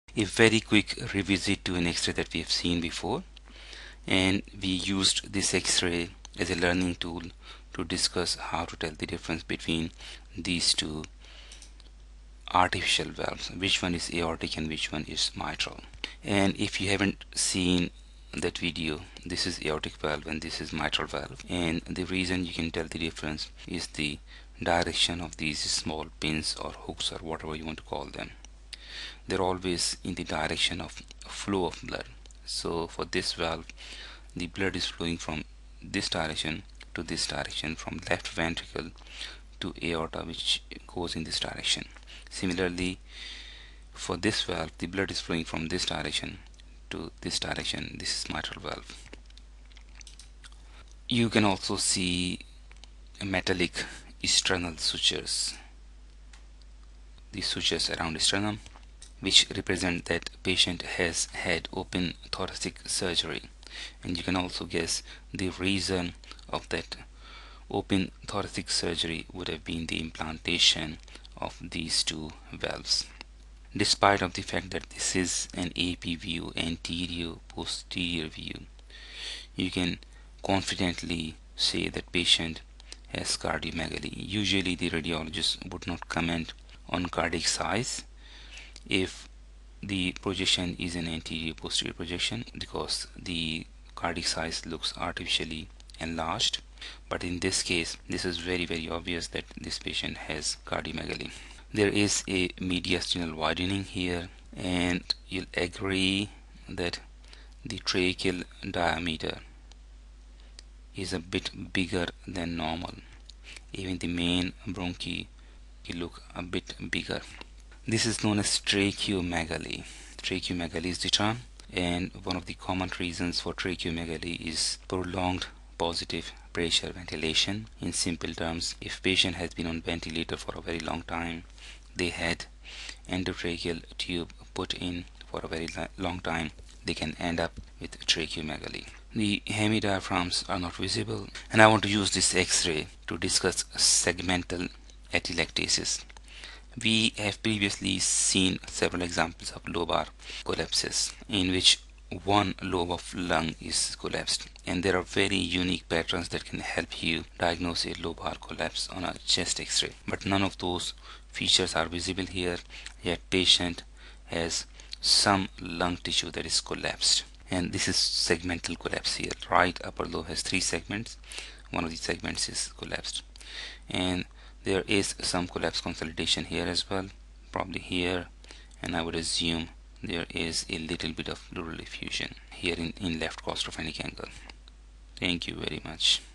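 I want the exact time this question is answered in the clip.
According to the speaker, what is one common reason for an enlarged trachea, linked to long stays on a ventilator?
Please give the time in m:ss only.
2:04.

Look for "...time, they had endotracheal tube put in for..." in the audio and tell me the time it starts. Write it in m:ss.
2:11.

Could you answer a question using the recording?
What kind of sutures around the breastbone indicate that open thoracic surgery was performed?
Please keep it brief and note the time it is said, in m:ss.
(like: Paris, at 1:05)
metallic sternal sutures, at 0:53.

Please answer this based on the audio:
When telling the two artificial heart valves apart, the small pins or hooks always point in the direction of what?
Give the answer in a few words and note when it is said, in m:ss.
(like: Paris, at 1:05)
flow of blood, at 0:31.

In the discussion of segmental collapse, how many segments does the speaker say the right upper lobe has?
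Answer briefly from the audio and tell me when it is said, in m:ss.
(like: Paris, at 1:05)
3, at 2:50.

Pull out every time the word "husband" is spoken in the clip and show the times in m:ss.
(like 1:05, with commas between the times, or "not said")
not said.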